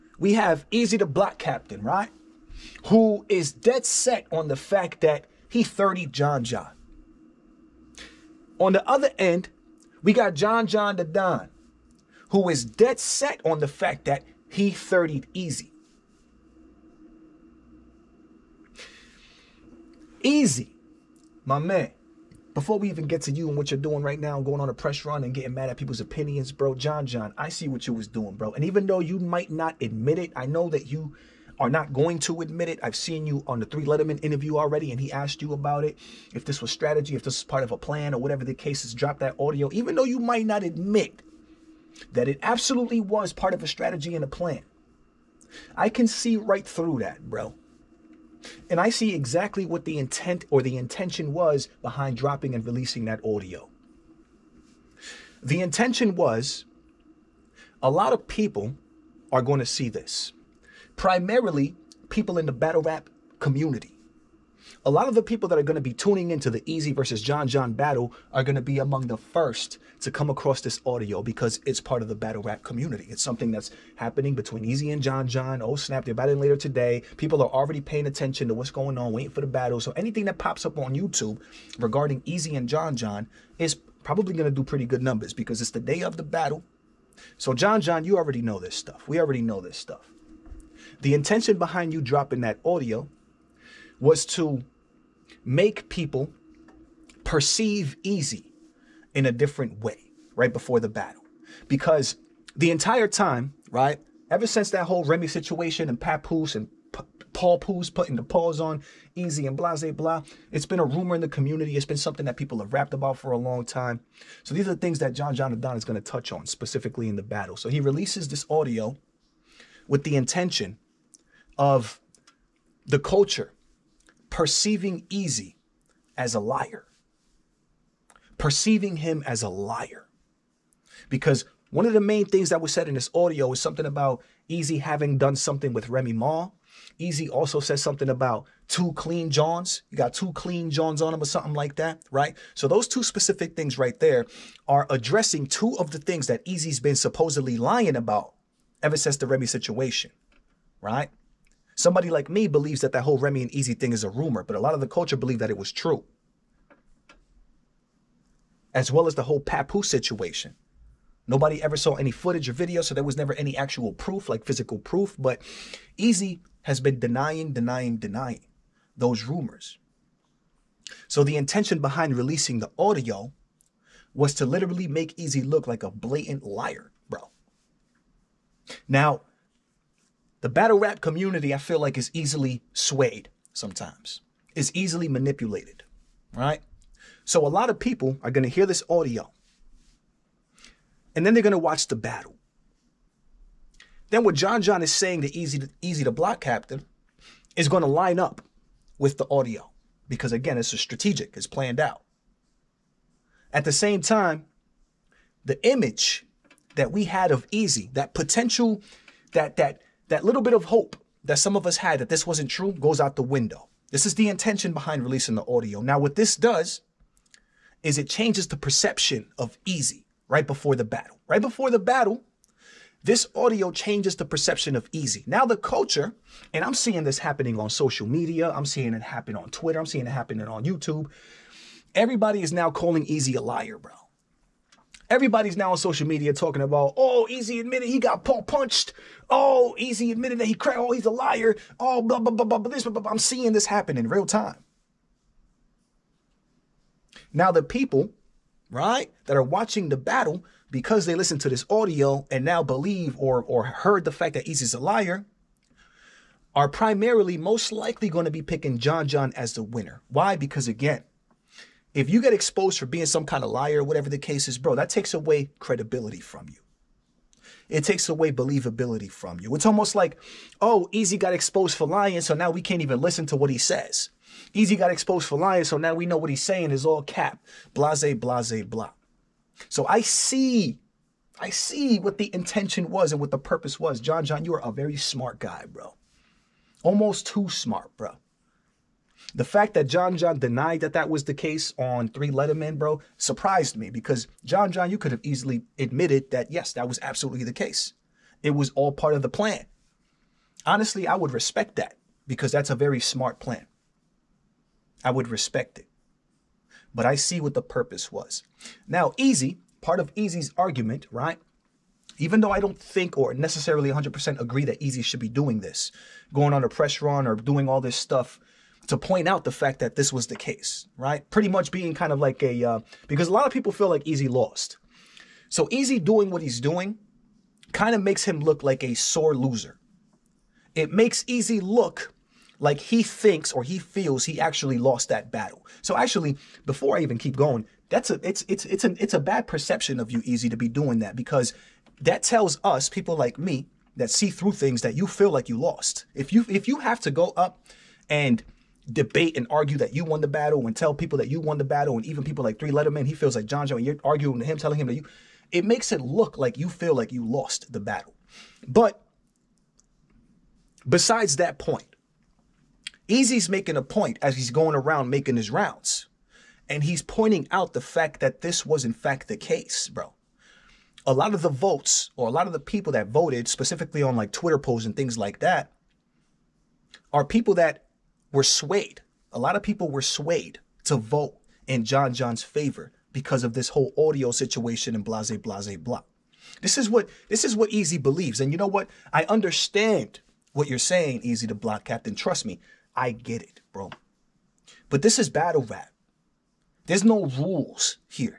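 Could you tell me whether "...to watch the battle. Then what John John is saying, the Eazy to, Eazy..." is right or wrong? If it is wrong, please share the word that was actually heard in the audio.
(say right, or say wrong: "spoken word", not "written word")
right.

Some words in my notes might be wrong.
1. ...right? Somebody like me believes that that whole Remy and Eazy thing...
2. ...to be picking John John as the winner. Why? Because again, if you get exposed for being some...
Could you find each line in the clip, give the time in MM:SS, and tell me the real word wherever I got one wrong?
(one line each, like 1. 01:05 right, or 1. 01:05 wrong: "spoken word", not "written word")
1. 02:30 right
2. 04:18 right.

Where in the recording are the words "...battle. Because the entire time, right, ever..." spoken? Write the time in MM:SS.
01:40.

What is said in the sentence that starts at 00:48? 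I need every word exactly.
And I see exactly what the intent or the intention was behind dropping and releasing that audio.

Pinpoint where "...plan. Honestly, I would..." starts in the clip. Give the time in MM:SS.
04:59.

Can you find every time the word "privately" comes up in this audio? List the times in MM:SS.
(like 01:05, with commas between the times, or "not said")
not said.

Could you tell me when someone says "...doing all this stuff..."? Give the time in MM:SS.
05:17.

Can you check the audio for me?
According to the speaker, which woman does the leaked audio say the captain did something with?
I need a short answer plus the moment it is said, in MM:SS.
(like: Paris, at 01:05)
Remy Ma, at 02:15.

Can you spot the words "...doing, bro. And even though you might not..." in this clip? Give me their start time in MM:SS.
00:28.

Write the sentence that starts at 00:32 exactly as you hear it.
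I've seen you on the 3Letterman interview already, and he asked you about it.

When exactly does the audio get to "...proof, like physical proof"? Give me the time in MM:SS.
02:43.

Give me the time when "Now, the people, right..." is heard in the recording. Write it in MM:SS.
04:07.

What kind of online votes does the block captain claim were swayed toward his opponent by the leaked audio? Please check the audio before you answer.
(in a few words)
Twitter polls.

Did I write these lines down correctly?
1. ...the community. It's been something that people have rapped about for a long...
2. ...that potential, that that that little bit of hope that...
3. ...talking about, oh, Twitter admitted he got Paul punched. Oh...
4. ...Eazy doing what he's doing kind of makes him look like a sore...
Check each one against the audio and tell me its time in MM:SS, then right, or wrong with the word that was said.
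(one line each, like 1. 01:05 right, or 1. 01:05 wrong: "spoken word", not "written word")
1. 01:51 right
2. 03:27 right
3. 03:56 wrong: "Eazy", not "Twitter"
4. 05:25 right.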